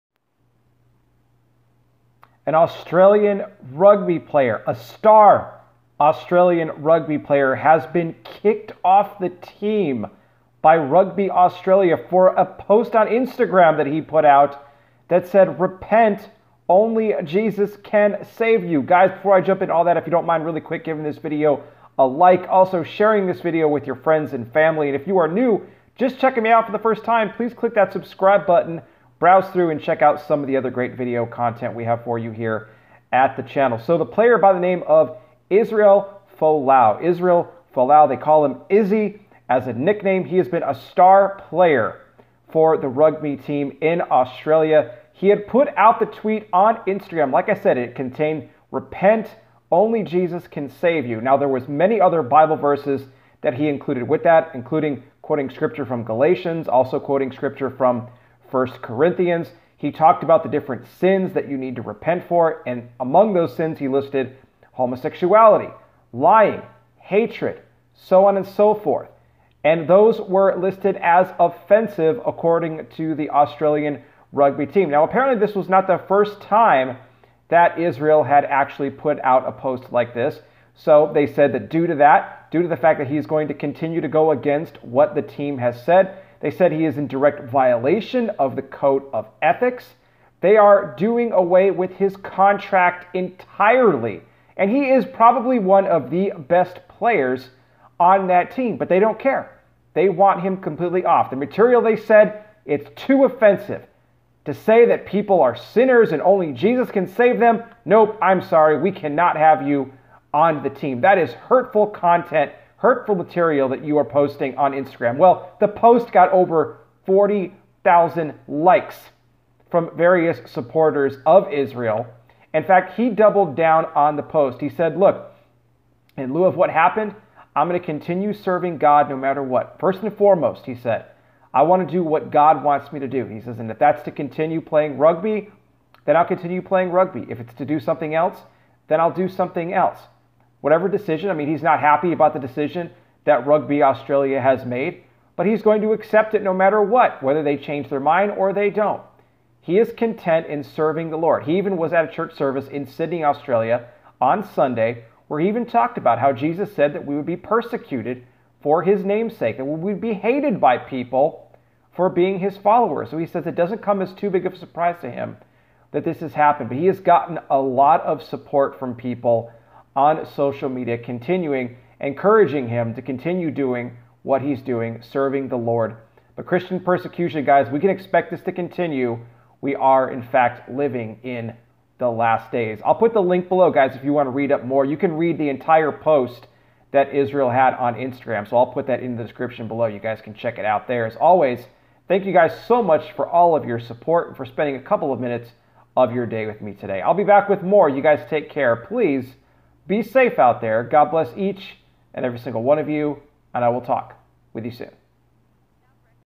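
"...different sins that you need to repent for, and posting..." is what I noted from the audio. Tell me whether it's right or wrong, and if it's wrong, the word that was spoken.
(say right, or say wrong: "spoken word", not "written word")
wrong: "among", not "posting".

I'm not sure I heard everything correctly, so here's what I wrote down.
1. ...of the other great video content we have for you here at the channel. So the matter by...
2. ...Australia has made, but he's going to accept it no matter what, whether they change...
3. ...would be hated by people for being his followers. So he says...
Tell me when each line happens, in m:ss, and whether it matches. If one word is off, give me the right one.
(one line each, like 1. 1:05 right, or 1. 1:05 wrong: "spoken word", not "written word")
1. 0:30 wrong: "player", not "matter"
2. 2:23 right
3. 2:39 right.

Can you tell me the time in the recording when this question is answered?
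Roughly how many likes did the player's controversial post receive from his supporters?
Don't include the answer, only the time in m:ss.
1:57.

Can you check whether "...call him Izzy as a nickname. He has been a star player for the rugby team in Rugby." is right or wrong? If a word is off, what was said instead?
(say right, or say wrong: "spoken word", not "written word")
wrong: "Australia", not "Rugby".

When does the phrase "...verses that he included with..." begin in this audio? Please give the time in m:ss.
0:52.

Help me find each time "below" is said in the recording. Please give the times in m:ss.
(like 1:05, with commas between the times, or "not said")
3:03, 3:09.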